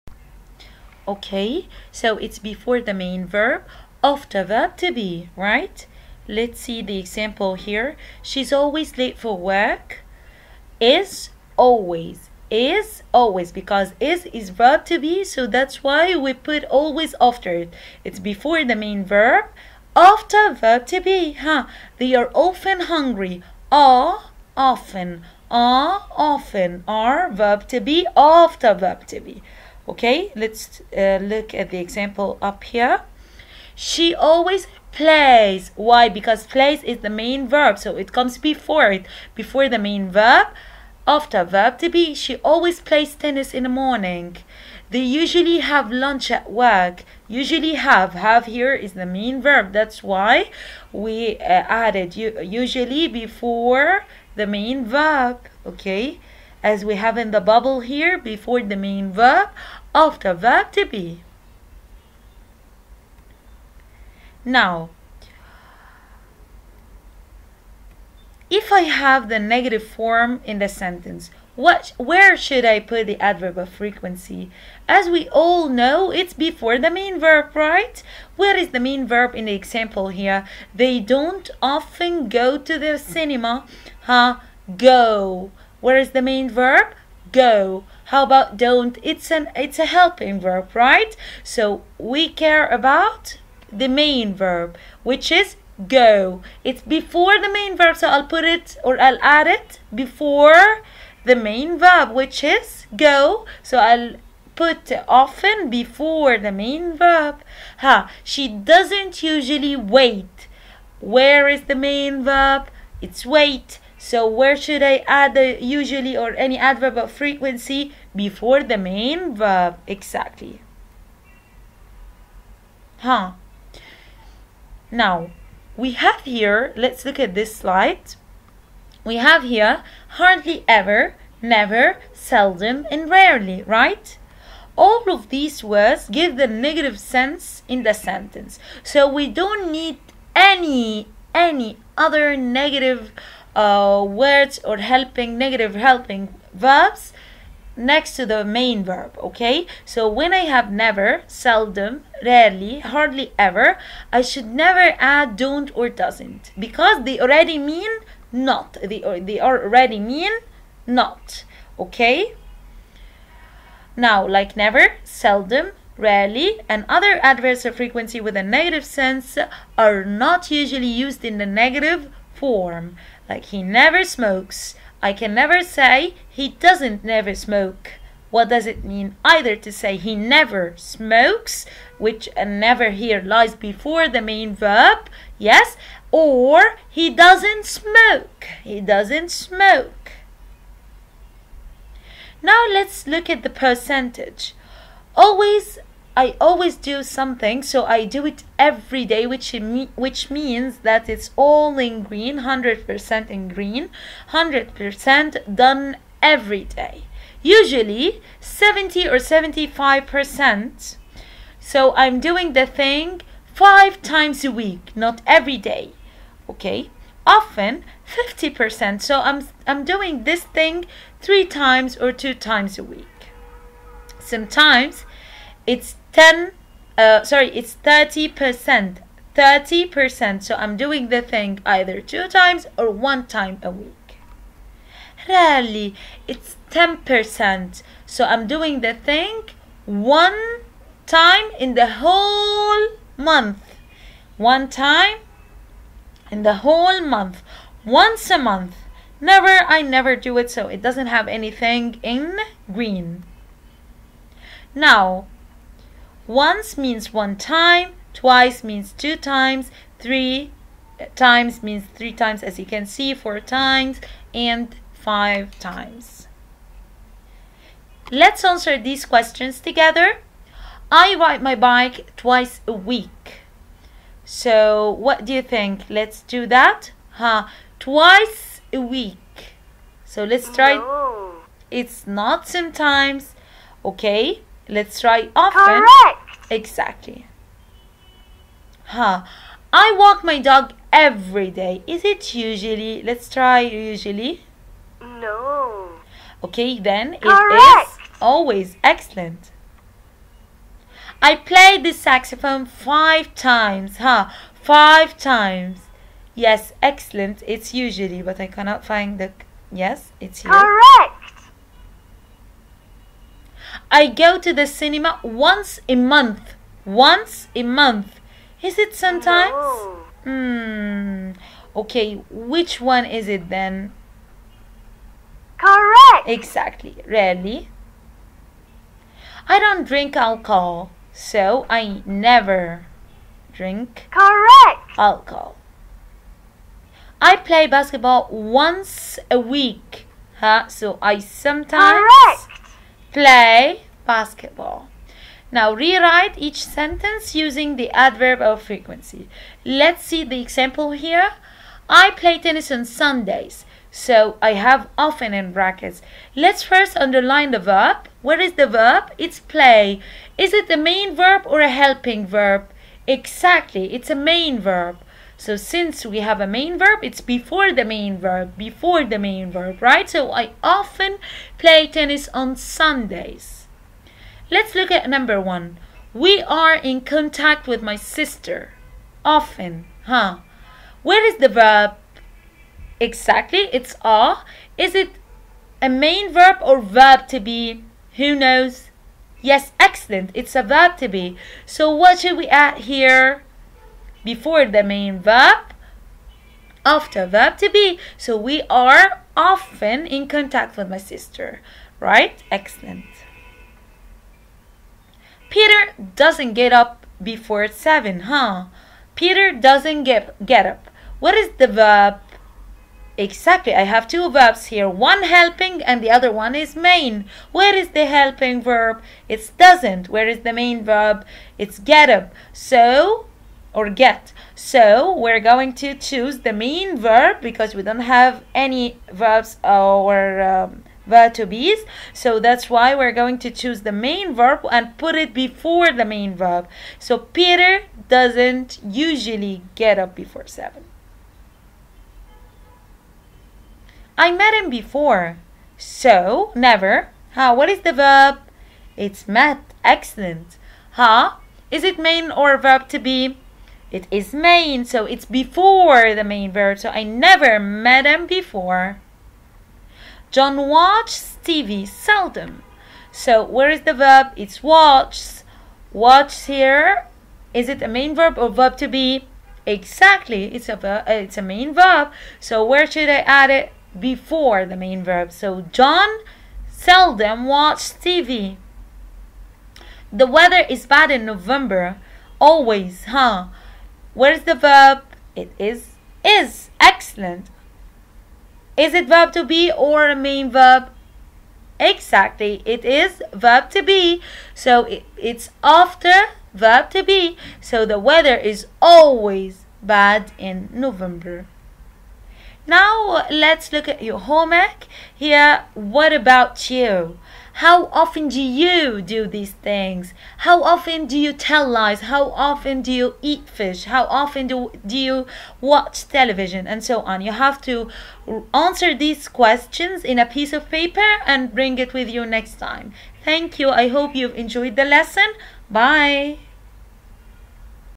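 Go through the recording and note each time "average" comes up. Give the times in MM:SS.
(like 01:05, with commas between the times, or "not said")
not said.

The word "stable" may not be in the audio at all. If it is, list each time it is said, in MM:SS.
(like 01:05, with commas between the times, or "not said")
not said.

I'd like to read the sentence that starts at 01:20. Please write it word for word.
They don't often go to the cinema.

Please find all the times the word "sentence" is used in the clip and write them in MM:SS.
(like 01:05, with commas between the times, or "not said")
01:10, 02:17, 05:46.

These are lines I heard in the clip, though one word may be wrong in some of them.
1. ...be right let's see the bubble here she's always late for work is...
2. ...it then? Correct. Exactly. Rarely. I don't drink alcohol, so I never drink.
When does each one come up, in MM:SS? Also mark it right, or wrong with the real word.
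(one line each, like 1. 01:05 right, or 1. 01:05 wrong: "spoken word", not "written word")
1. 00:04 wrong: "example", not "bubble"
2. 05:23 right.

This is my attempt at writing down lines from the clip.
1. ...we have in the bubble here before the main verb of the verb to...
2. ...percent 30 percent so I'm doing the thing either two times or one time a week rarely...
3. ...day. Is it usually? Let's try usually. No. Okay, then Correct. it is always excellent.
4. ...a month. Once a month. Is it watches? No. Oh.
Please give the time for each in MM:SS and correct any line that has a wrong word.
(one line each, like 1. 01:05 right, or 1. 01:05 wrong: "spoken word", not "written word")
1. 00:56 right
2. 03:48 right
3. 04:51 right
4. 05:15 wrong: "sometimes", not "watches".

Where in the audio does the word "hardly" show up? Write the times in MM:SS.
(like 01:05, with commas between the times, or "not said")
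02:10, 02:32.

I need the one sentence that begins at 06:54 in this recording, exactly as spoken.
One helping and the other one is main.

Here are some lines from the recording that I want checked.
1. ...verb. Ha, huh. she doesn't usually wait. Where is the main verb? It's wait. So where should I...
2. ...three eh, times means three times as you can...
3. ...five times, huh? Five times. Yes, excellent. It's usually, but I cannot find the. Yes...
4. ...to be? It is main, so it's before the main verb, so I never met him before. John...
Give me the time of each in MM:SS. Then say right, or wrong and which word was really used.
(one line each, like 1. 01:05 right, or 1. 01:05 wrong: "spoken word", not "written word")
1. 01:46 right
2. 04:19 right
3. 05:02 right
4. 07:32 right.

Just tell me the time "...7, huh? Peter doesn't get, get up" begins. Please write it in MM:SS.
06:47.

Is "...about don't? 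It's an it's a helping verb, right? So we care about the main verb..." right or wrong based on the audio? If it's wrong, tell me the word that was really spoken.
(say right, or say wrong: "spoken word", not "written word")
right.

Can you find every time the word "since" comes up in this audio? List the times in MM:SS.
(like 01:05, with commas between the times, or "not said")
06:05.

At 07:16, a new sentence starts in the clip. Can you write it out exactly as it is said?
So Peter doesn't usually get up before 7.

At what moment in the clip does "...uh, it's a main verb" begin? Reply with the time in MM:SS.
07:51.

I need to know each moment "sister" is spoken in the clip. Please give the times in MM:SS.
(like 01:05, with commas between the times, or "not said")
06:17, 06:40.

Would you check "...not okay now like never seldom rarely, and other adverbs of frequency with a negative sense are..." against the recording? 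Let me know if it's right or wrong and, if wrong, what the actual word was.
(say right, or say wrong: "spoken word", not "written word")
right.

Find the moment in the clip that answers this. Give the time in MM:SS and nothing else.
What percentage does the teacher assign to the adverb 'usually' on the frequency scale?
03:28.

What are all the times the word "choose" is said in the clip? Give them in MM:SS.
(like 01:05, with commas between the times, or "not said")
07:05, 07:13.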